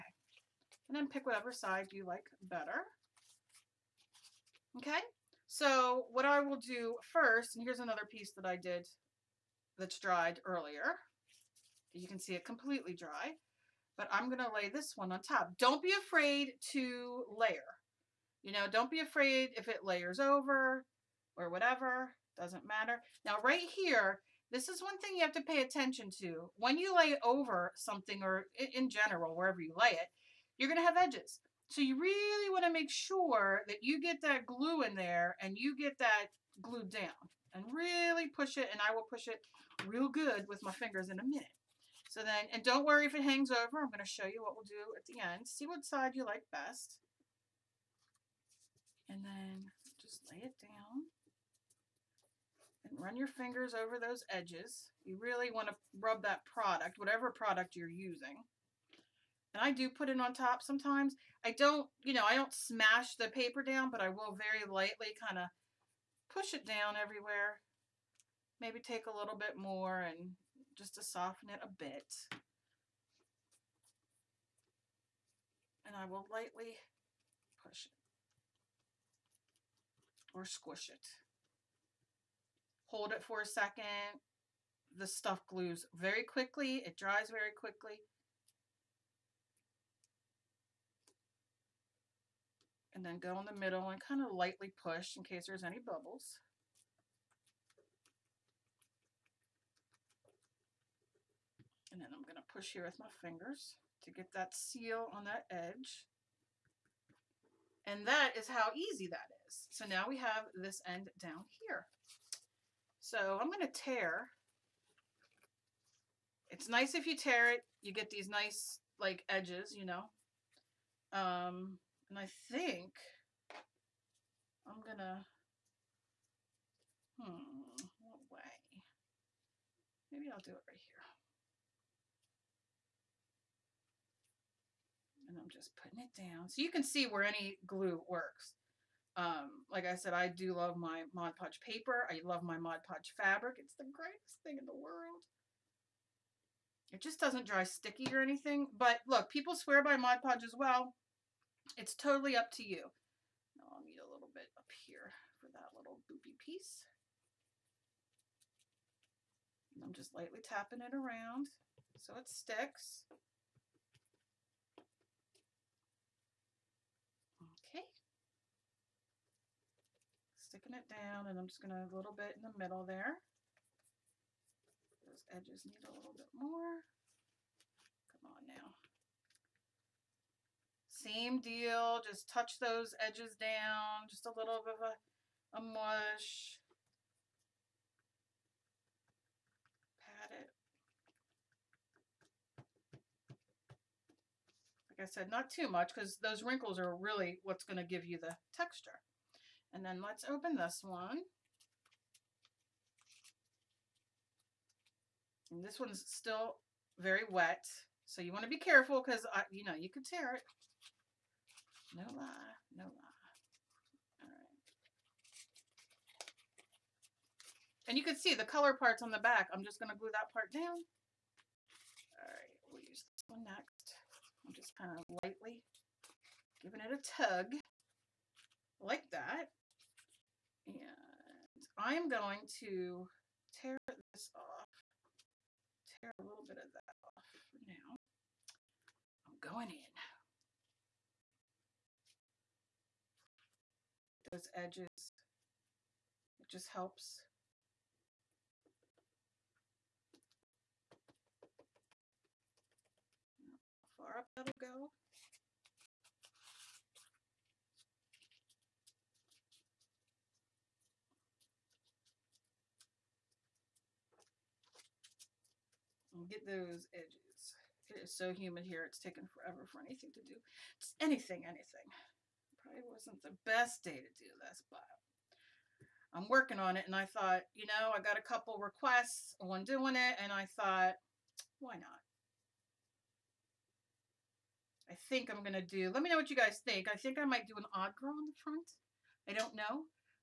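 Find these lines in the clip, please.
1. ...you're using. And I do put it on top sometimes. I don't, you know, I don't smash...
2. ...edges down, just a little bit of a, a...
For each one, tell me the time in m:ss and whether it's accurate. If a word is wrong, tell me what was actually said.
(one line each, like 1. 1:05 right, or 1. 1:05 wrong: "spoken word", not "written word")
1. 0:57 right
2. 3:03 right.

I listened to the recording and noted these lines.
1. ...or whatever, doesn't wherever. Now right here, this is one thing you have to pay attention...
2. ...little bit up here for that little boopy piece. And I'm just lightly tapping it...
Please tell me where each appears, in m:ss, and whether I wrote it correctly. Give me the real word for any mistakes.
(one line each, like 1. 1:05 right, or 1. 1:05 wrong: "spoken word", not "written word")
1. 0:21 wrong: "matter", not "wherever"
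2. 2:34 right.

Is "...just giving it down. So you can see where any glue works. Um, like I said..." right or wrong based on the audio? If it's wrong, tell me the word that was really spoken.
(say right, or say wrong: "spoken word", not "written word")
wrong: "putting", not "giving".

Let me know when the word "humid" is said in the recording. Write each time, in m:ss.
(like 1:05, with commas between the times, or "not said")
4:28.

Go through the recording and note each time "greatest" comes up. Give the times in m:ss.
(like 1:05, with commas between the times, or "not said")
2:23.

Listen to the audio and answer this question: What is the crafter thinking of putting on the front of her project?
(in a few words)
an odd girl.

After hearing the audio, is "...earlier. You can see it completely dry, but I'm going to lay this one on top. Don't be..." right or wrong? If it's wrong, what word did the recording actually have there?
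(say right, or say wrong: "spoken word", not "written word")
right.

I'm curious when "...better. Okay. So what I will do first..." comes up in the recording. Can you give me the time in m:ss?
0:02.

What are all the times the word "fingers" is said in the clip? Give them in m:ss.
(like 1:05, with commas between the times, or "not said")
0:40, 0:53, 1:43.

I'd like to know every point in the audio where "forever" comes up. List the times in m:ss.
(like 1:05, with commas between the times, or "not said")
4:29.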